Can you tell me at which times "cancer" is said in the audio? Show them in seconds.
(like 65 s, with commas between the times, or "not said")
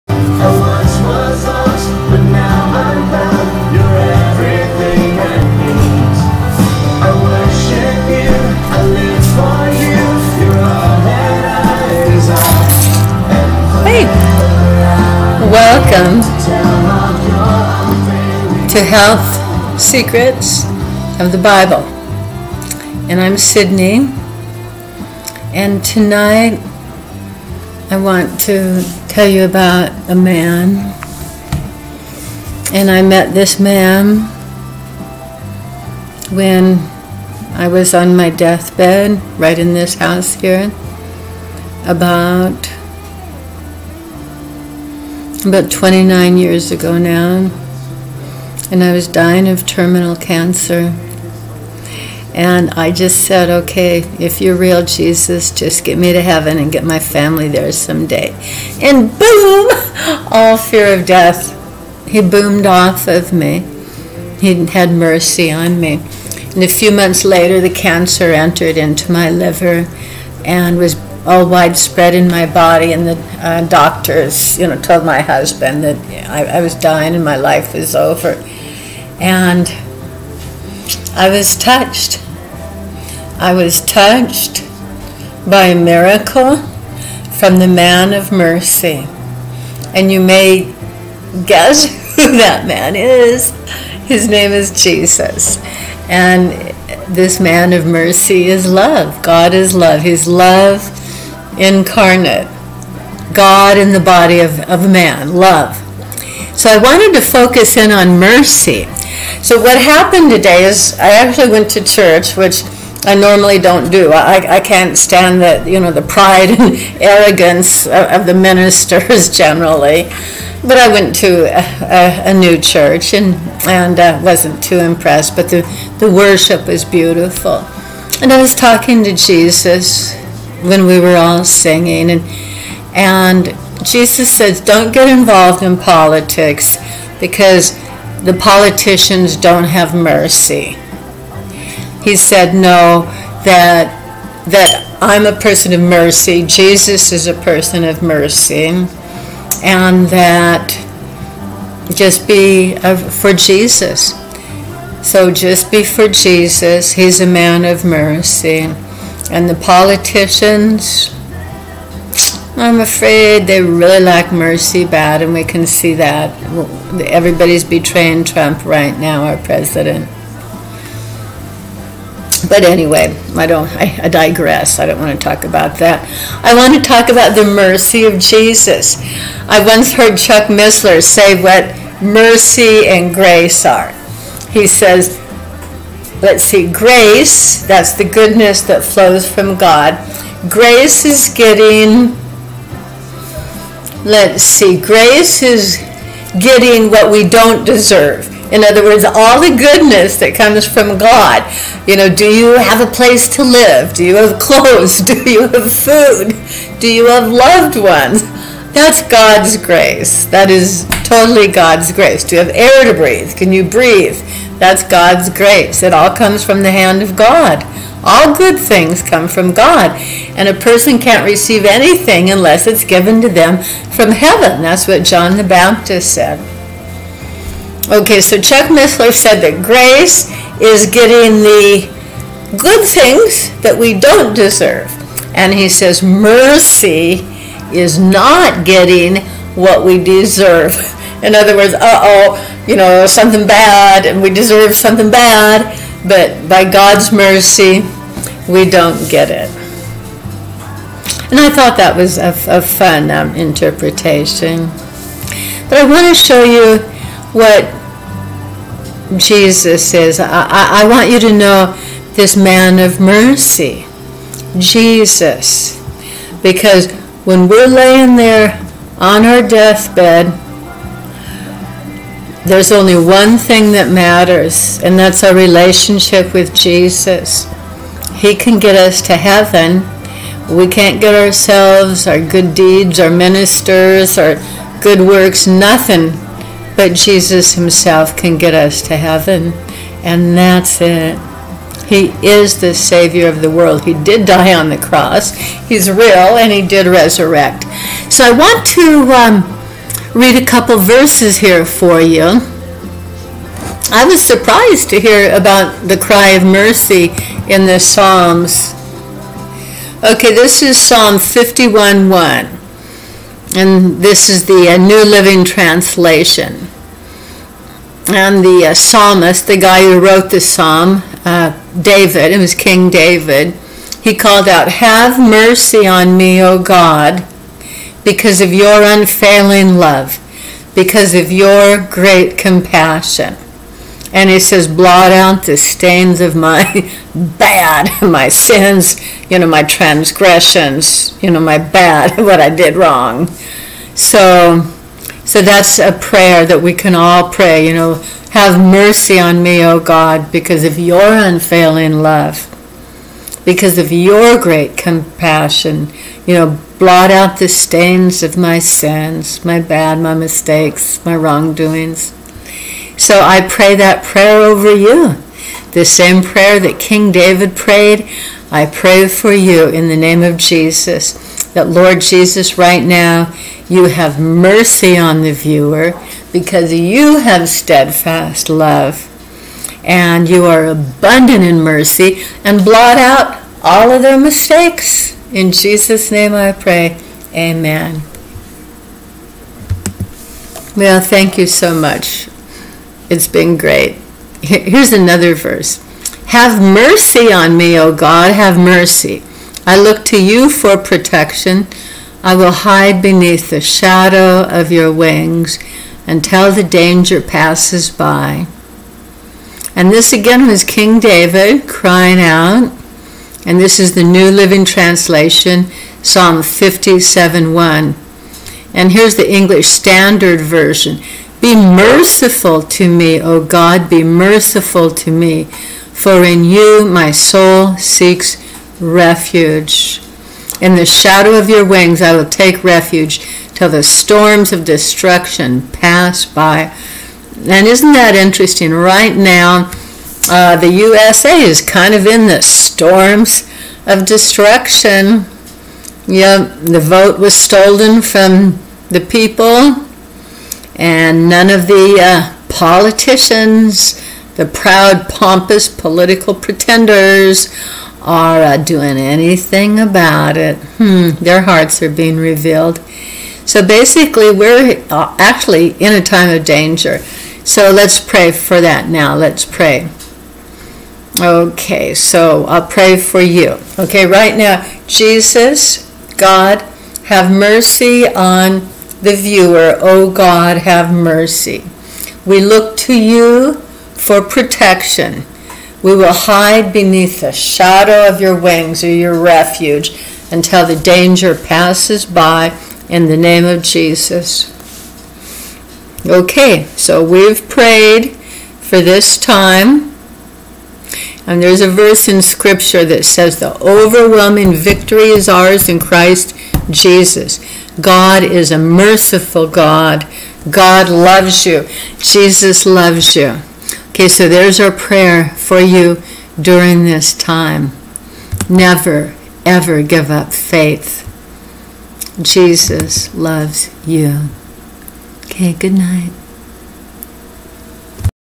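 50 s, 67 s.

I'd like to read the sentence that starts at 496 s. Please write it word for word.
Okay, so we've prayed for this time.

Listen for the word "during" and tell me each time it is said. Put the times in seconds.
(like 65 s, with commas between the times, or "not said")
516 s.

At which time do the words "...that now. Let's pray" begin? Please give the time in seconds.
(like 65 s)
468 s.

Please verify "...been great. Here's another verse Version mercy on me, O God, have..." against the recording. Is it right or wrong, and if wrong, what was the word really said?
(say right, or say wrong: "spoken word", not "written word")
wrong: "Have", not "Version".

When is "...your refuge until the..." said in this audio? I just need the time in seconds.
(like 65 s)
488 s.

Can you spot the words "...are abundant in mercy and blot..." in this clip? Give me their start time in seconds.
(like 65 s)
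380 s.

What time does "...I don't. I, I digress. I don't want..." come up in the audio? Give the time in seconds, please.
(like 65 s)
173 s.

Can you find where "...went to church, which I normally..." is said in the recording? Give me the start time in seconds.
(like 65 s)
111 s.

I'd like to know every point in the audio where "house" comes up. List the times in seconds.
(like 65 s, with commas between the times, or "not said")
39 s.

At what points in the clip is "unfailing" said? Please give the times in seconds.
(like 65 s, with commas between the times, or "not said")
328 s, 351 s.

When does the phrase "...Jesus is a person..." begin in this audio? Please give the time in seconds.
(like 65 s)
146 s.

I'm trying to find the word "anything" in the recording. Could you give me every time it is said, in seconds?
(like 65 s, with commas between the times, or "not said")
221 s, 458 s.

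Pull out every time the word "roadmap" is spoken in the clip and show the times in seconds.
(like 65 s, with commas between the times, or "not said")
not said.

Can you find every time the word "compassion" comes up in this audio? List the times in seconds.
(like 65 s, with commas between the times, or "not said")
332 s, 354 s.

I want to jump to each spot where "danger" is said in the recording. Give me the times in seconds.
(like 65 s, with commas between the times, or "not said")
406 s, 466 s, 490 s.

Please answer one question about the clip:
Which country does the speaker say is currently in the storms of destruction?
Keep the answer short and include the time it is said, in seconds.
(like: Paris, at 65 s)
USA, at 440 s.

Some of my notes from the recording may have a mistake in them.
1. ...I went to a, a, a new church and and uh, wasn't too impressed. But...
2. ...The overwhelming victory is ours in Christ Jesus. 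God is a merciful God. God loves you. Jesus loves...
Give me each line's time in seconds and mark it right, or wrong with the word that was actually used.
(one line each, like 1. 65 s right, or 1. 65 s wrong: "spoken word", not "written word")
1. 120 s right
2. 503 s right.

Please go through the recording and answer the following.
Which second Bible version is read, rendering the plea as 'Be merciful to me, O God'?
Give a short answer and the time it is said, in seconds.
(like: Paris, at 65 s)
English Standard Version, at 419 s.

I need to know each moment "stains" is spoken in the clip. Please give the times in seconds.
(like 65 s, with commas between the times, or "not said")
335 s, 357 s.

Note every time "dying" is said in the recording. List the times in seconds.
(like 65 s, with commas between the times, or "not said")
49 s, 76 s.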